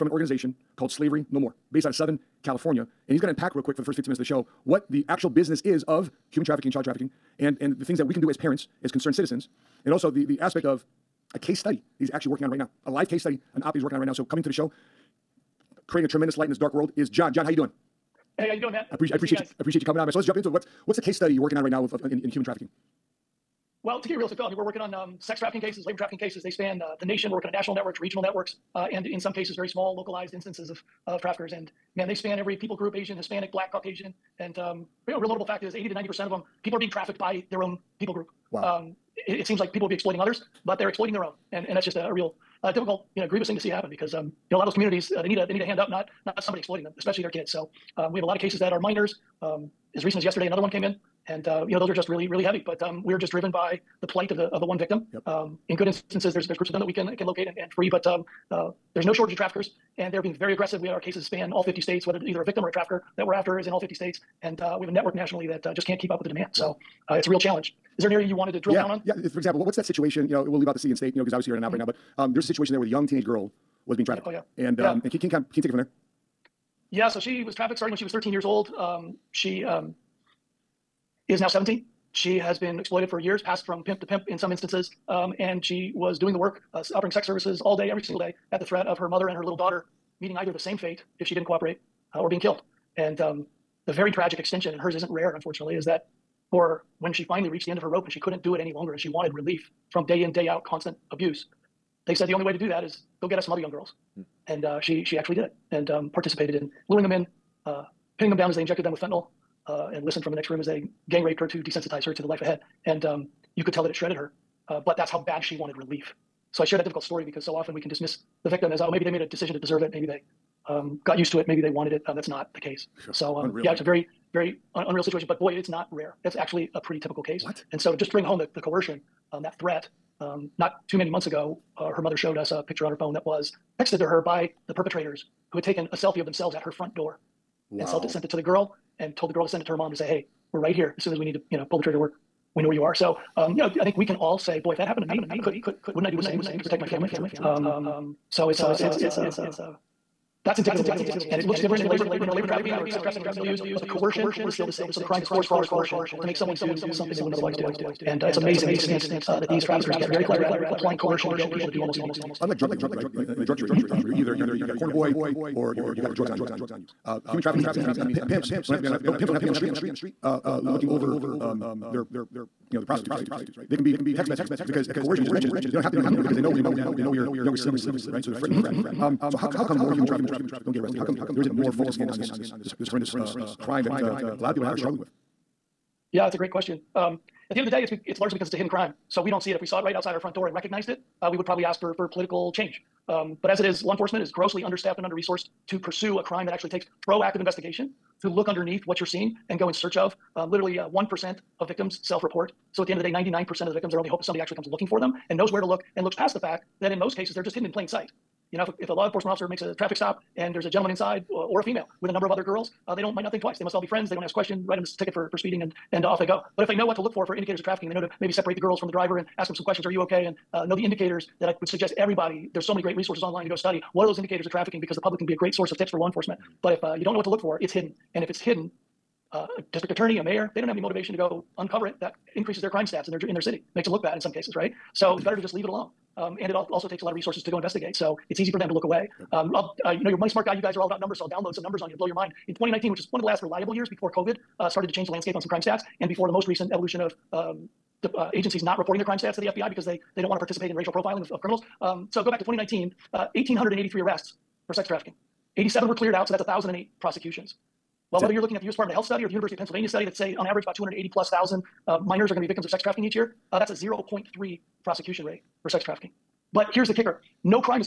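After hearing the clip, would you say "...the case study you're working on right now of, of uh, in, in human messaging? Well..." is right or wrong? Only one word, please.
wrong.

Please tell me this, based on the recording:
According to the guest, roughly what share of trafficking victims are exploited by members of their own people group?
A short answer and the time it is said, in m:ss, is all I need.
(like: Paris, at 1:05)
80 to 90%, at 0:35.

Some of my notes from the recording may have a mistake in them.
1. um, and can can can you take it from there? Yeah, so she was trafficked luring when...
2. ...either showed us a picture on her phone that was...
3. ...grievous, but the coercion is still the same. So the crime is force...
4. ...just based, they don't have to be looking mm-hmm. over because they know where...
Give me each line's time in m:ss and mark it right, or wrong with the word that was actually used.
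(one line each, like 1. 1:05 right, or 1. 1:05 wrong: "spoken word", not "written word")
1. 1:14 wrong: "starting", not "luring"
2. 2:12 wrong: "mother", not "either"
3. 2:33 wrong: "milieus", not "grievous"
4. 2:55 wrong: "mentioned", not "based".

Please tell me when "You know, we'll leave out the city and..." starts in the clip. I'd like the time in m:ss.
1:10.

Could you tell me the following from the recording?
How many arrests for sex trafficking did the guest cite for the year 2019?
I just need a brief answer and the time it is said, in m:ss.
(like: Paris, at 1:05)
1,883, at 4:13.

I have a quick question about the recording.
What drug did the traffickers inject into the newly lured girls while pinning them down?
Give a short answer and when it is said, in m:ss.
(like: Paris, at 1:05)
fentanyl, at 1:49.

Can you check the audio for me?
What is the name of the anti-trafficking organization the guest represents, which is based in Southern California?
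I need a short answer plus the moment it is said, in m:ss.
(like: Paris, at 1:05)
Slavery No More, at 0:00.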